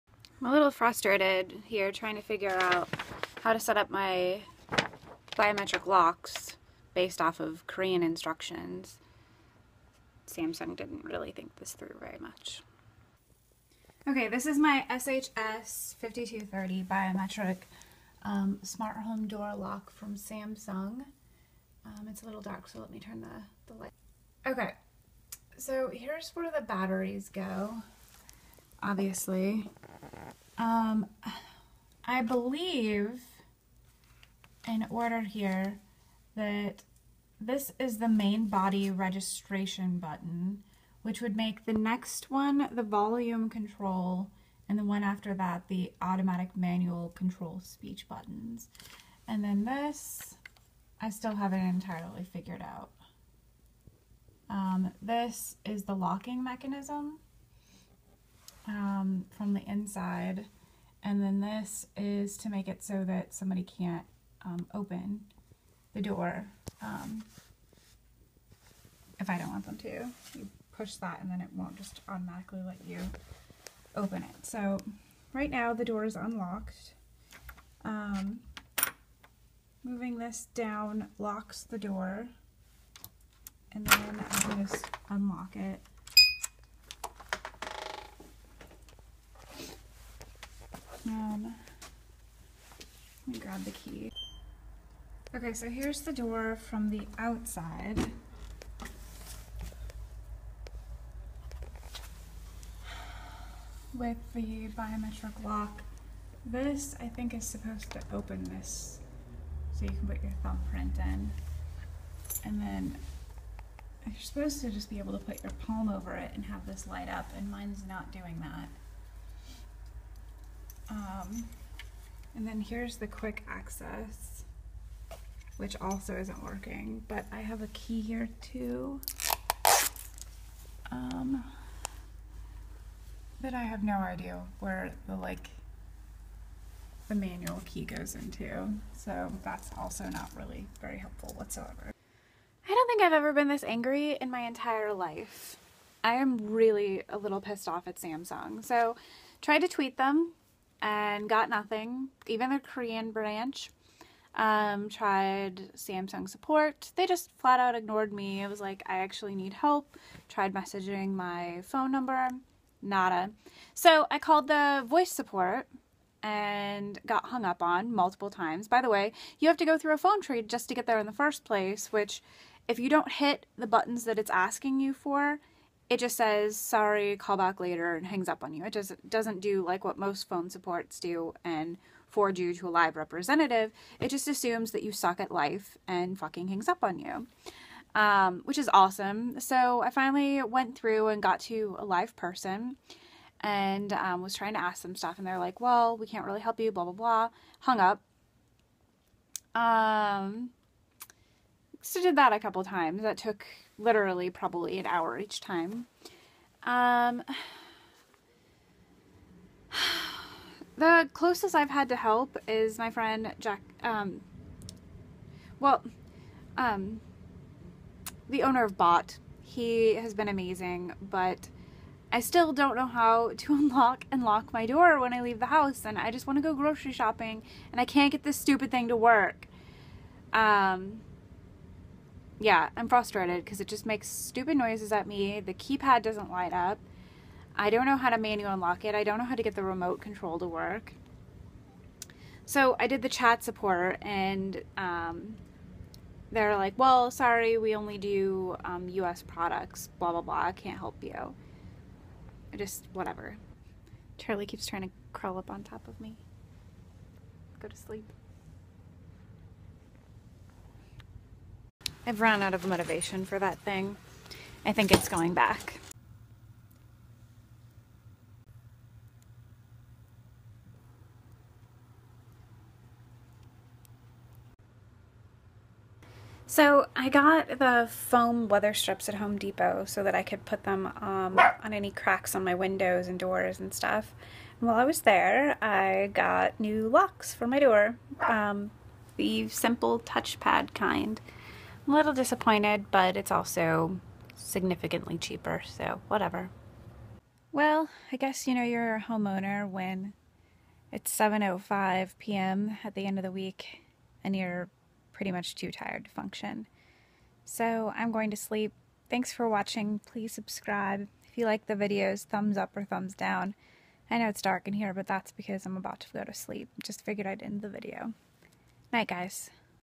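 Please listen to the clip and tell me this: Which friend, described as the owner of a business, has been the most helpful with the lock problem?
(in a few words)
Jack.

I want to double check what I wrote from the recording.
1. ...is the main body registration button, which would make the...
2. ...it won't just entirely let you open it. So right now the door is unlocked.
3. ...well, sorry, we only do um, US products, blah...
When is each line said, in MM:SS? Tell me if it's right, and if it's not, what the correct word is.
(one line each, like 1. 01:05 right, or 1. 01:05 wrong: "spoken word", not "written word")
1. 00:37 right
2. 01:11 wrong: "automatically", not "entirely"
3. 04:06 right.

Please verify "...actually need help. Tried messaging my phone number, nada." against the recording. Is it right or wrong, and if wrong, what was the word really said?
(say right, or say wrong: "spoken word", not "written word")
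right.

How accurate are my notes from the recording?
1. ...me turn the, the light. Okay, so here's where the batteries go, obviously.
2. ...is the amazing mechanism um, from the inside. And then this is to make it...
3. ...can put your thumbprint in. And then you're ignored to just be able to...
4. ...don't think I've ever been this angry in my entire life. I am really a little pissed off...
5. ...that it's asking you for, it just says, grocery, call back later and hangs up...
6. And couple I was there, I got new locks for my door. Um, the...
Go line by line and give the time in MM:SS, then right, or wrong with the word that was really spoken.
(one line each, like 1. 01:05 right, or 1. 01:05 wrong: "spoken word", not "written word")
1. 00:22 right
2. 00:55 wrong: "locking", not "amazing"
3. 01:49 wrong: "supposed", not "ignored"
4. 02:22 right
5. 02:54 wrong: "sorry", not "grocery"
6. 04:44 wrong: "while", not "couple".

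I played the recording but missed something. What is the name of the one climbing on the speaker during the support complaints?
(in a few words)
Charlie.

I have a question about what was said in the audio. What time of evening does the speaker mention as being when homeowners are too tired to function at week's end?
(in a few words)
7:05 p.m.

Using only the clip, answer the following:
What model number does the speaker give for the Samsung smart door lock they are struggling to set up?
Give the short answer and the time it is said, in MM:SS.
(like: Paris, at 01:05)
SHS 5230, at 00:14.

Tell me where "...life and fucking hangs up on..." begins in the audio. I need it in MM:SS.
03:05.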